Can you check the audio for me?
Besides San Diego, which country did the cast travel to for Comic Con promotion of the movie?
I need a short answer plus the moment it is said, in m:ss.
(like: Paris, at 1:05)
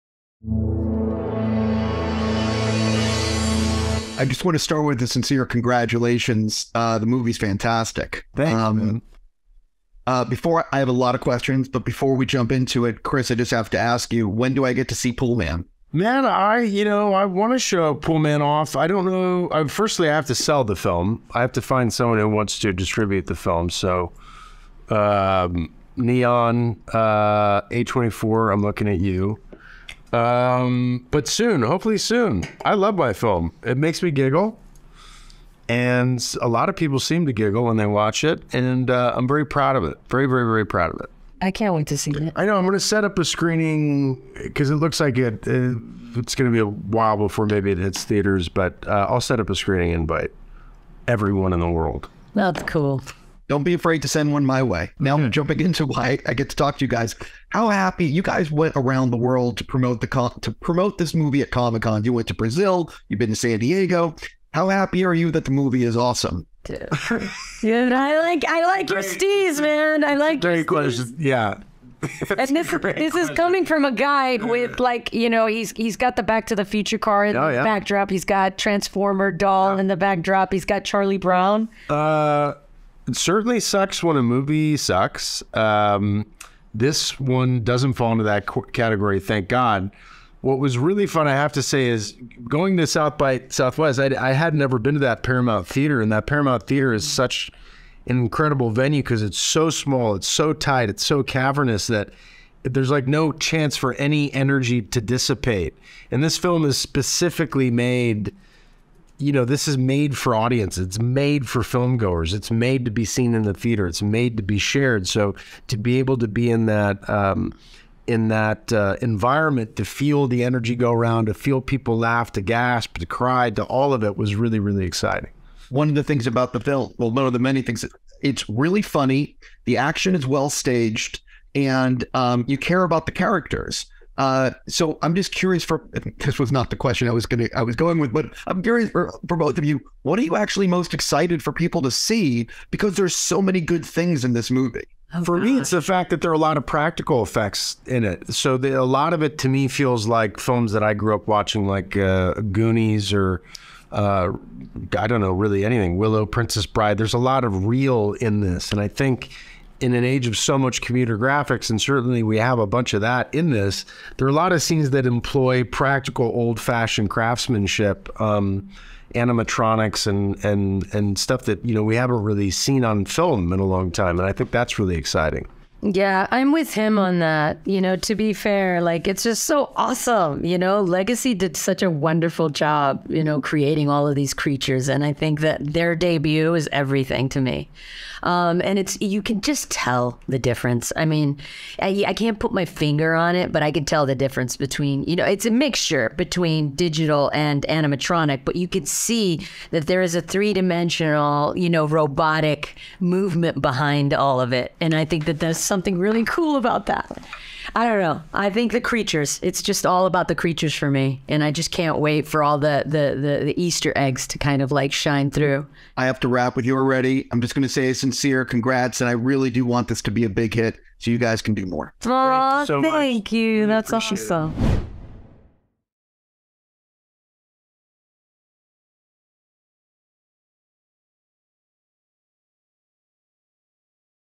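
Brazil, at 1:02.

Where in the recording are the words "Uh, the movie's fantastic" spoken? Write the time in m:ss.
0:06.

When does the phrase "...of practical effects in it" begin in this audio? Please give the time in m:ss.
2:26.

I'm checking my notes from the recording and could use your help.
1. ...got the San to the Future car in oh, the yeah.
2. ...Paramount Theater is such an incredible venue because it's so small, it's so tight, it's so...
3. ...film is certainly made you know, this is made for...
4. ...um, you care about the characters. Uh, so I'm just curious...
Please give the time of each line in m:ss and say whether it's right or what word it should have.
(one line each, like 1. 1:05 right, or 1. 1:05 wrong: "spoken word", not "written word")
1. 1:15 wrong: "Back", not "San"
2. 1:36 right
3. 1:46 wrong: "specifically", not "certainly"
4. 2:12 right.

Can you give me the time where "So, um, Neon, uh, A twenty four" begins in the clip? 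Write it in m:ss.
0:23.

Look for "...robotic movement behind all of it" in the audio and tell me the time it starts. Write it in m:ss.
3:21.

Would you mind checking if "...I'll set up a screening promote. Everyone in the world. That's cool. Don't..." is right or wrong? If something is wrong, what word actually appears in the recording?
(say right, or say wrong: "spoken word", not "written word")
wrong: "invite", not "promote".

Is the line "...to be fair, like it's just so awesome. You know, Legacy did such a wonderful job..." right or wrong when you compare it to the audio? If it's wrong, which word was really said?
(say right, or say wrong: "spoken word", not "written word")
right.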